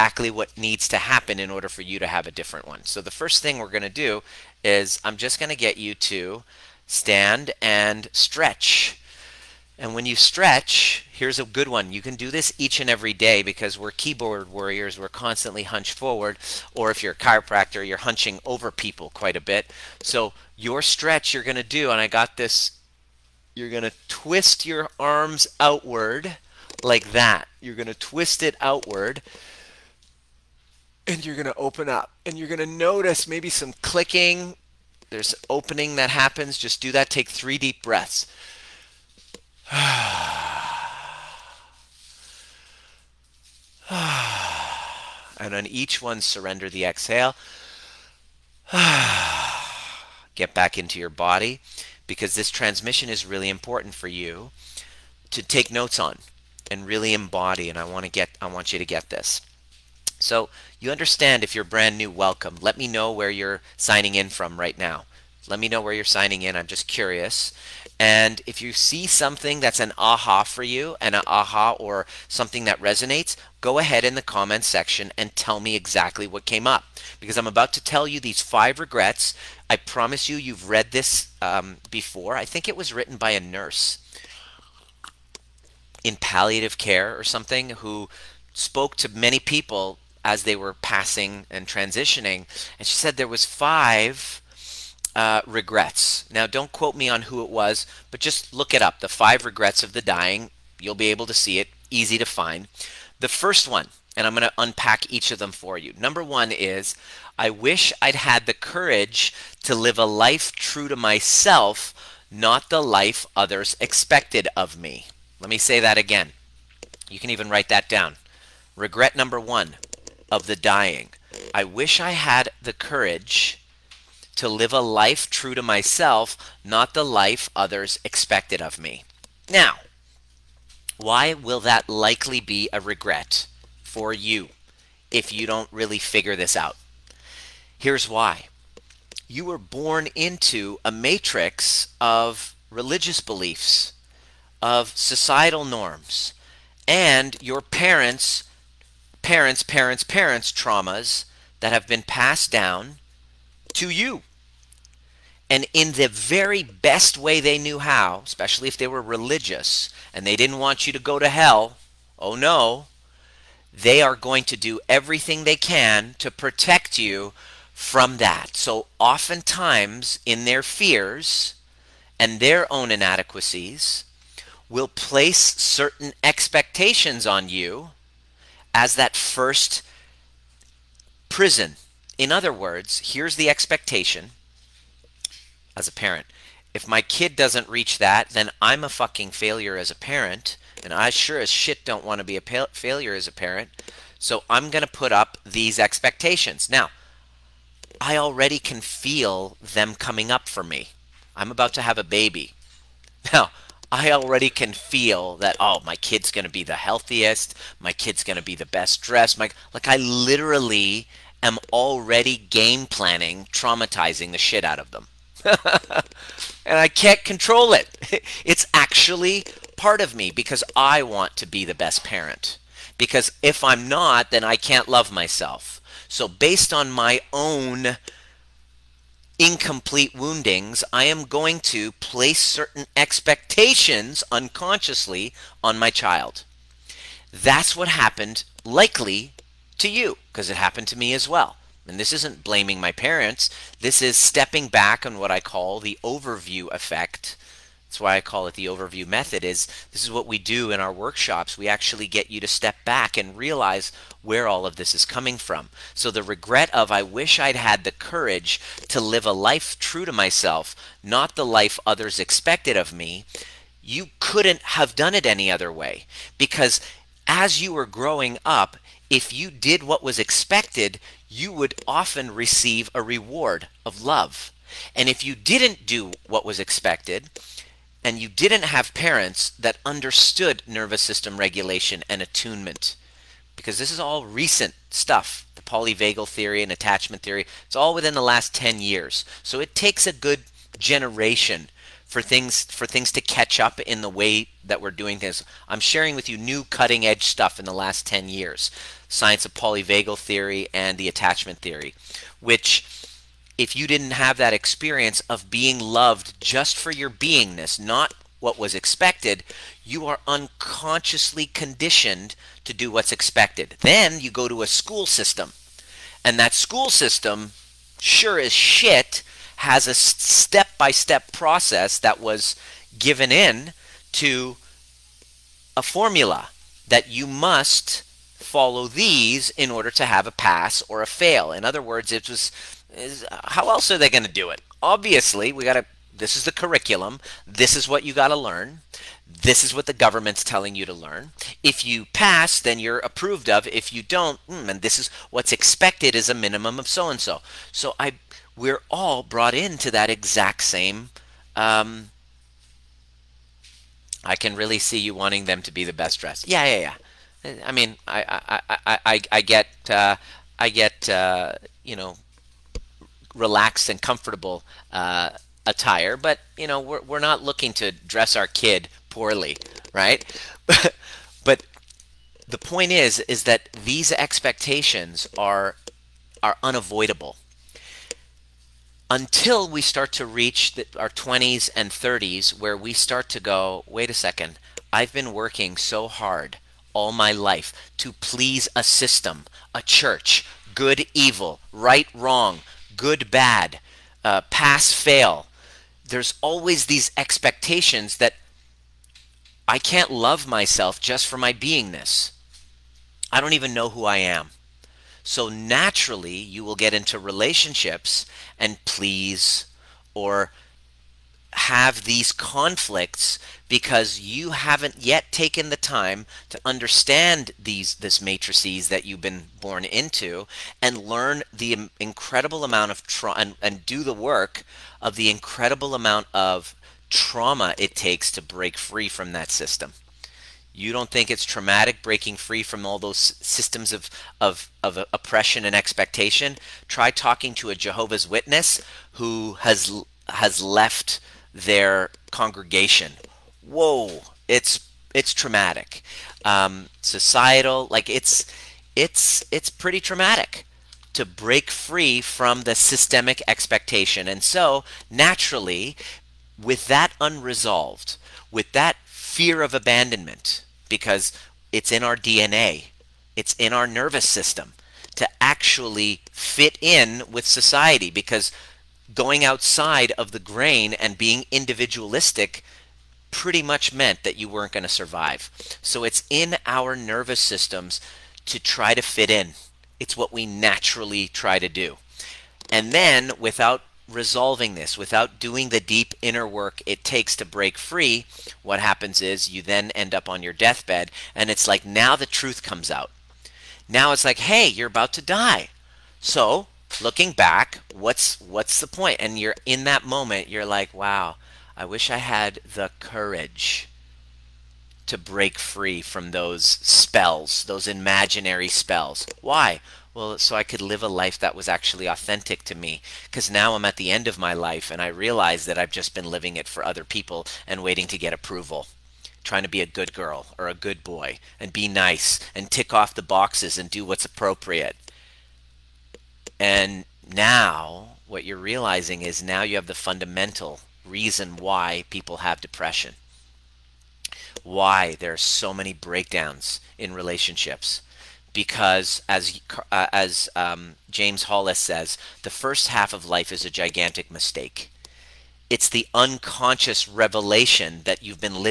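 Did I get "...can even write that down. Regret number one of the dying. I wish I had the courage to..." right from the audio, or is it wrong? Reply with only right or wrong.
right.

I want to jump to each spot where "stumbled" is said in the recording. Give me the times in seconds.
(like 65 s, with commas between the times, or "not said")
not said.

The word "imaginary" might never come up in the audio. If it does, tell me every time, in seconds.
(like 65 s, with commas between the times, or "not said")
507 s.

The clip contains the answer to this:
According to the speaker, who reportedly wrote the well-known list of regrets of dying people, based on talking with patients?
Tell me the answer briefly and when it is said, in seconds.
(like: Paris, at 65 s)
A nurse in palliative care, at 83 s.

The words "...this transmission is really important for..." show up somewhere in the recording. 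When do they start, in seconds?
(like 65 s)
52 s.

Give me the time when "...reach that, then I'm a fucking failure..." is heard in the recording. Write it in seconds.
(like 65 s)
187 s.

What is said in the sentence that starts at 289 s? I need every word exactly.
So it takes a good generation for things for things to catch up in the way that we're doing things.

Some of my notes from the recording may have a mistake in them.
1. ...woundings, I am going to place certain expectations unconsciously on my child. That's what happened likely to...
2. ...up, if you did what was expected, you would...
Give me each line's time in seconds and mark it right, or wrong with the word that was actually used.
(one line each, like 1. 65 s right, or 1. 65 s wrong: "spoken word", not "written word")
1. 230 s right
2. 268 s right.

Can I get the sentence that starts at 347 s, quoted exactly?
So I, we're all brought into that exact same.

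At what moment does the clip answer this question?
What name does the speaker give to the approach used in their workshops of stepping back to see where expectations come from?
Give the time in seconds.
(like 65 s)
248 s.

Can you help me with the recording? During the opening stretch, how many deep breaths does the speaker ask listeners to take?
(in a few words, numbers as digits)
3.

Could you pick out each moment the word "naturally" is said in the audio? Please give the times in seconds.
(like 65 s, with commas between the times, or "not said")
405 s, 455 s, 480 s.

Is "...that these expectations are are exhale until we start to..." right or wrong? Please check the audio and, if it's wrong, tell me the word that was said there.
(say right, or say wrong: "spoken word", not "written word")
wrong: "unavoidable", not "exhale".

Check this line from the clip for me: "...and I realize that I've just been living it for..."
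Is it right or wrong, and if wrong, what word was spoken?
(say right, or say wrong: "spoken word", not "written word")
right.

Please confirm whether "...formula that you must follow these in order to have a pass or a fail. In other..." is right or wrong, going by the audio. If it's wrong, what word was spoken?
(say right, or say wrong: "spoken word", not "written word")
right.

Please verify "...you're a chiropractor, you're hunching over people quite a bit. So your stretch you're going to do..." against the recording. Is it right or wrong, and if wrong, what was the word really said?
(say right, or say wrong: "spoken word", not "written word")
right.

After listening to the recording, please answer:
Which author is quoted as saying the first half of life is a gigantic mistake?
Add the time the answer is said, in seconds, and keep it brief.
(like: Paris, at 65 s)
James Hollis, at 541 s.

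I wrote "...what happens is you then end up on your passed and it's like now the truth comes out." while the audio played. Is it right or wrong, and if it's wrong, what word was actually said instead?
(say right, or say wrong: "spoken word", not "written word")
wrong: "deathbed", not "passed".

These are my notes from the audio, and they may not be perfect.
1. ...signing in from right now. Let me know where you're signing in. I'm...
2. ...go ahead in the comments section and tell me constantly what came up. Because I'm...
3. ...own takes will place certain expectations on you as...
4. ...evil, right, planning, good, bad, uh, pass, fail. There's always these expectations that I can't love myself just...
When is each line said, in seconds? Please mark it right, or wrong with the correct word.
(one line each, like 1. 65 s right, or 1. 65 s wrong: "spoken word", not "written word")
1. 63 s right
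2. 73 s wrong: "exactly", not "constantly"
3. 172 s wrong: "inadequacies", not "takes"
4. 391 s wrong: "wrong", not "planning".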